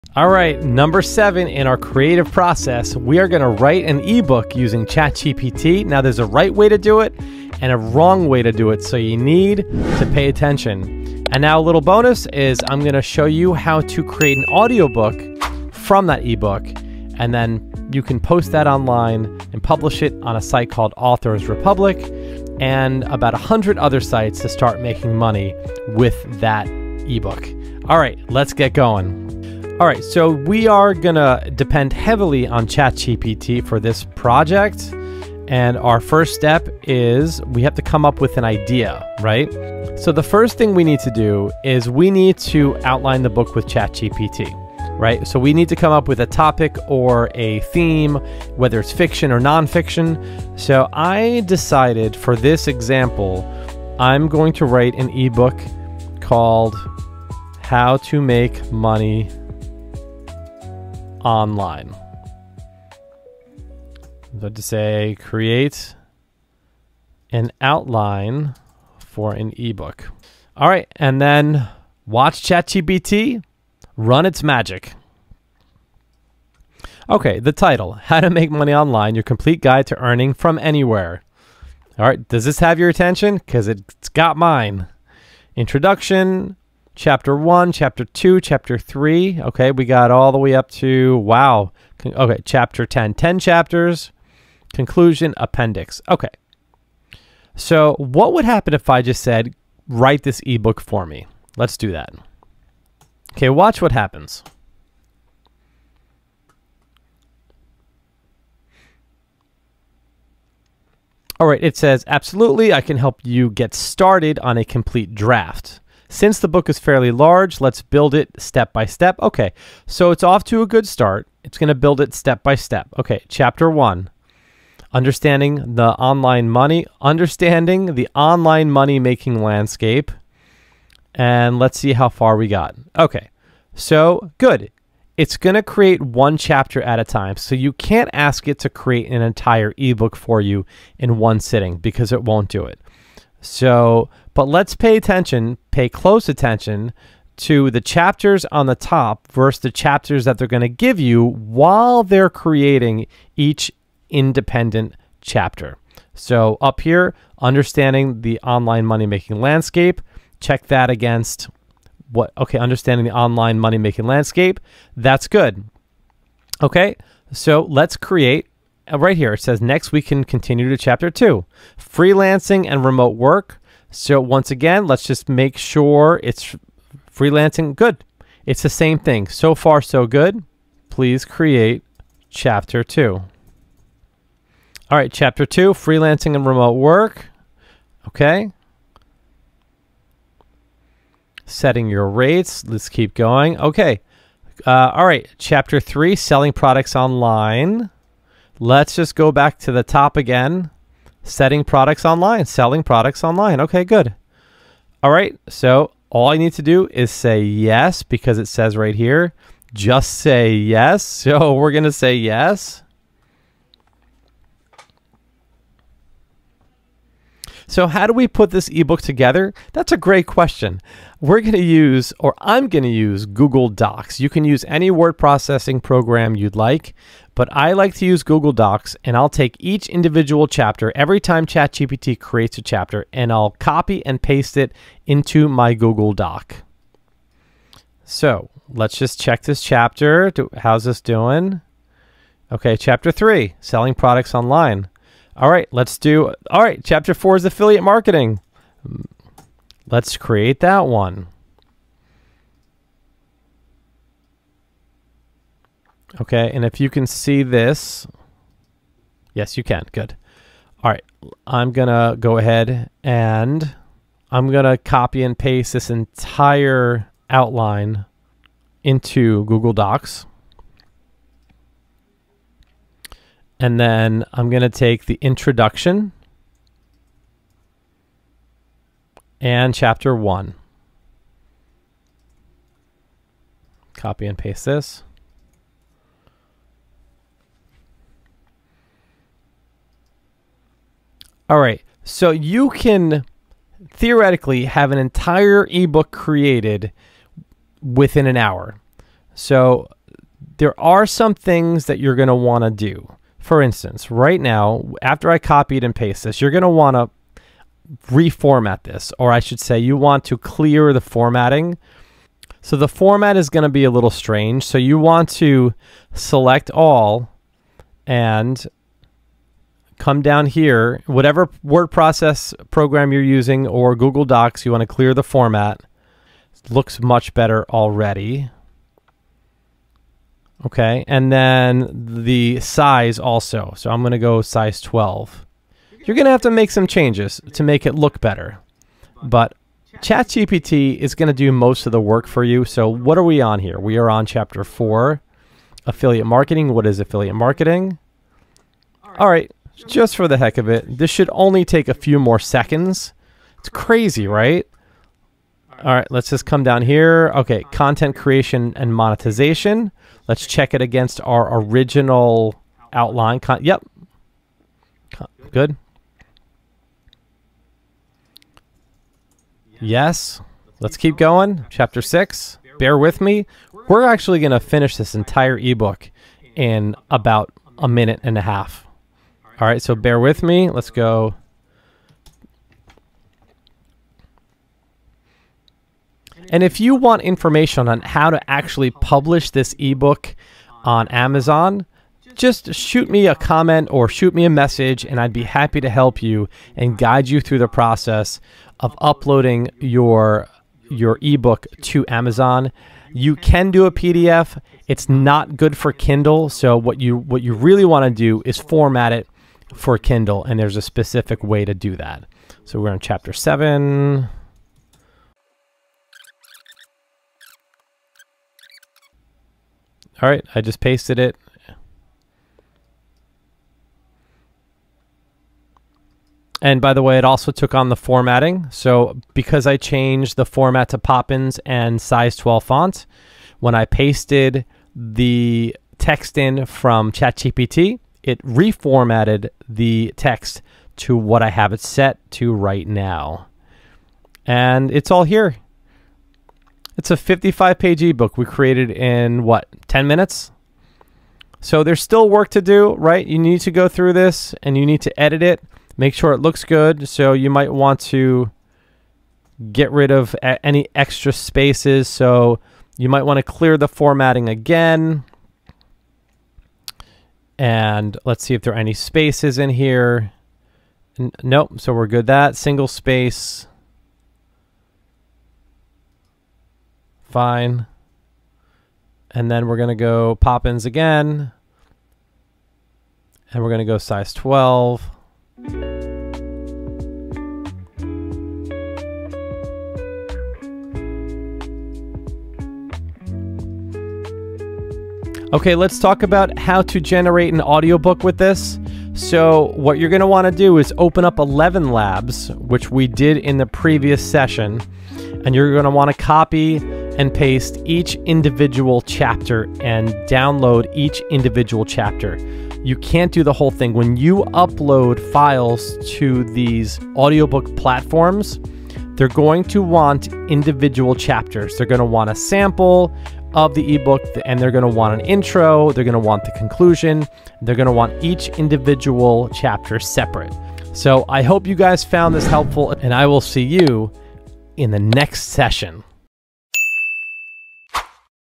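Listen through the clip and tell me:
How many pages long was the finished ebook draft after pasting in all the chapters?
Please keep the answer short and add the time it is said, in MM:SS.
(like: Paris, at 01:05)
55, at 07:27.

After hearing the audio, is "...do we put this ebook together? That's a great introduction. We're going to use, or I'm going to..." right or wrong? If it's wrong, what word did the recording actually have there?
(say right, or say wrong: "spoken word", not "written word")
wrong: "question", not "introduction".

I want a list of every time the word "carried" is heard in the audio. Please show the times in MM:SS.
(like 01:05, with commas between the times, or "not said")
not said.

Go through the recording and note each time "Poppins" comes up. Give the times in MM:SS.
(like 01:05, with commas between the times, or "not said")
07:10, 08:00.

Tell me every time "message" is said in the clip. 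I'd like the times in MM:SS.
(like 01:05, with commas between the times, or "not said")
06:34.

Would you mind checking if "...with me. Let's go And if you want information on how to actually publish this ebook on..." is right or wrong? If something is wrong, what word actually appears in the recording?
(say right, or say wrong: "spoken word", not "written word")
right.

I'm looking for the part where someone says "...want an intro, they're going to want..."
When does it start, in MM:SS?
08:44.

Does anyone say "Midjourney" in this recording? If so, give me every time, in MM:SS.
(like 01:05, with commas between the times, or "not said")
not said.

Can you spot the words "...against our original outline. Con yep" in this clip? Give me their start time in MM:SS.
06:00.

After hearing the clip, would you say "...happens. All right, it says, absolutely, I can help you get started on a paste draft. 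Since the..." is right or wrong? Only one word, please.
wrong.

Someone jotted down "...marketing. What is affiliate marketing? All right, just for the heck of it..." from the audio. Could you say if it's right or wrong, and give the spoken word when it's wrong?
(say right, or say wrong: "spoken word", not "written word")
right.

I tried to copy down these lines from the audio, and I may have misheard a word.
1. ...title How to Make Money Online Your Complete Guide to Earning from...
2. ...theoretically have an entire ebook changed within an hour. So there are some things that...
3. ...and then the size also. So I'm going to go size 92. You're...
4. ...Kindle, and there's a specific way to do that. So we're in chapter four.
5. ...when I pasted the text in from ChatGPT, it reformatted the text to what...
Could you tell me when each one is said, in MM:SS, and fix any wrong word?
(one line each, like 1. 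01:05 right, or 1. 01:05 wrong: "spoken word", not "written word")
1. 01:17 right
2. 04:53 wrong: "created", not "changed"
3. 05:31 wrong: "12", not "92"
4. 06:49 wrong: "seven", not "four"
5. 07:13 right.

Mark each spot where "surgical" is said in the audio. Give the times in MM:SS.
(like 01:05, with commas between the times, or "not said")
not said.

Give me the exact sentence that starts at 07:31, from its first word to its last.
So there's still work to do, right?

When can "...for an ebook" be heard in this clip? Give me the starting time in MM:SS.
01:08.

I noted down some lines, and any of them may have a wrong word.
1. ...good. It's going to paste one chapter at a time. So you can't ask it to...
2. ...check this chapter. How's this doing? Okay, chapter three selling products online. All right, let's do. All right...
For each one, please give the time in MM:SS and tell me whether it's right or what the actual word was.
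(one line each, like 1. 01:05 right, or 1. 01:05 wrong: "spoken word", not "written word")
1. 02:14 wrong: "create", not "paste"
2. 03:59 right.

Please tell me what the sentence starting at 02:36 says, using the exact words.
So, up here, understanding the online money making landscape, check that against what, okay, understanding the online money making landscape.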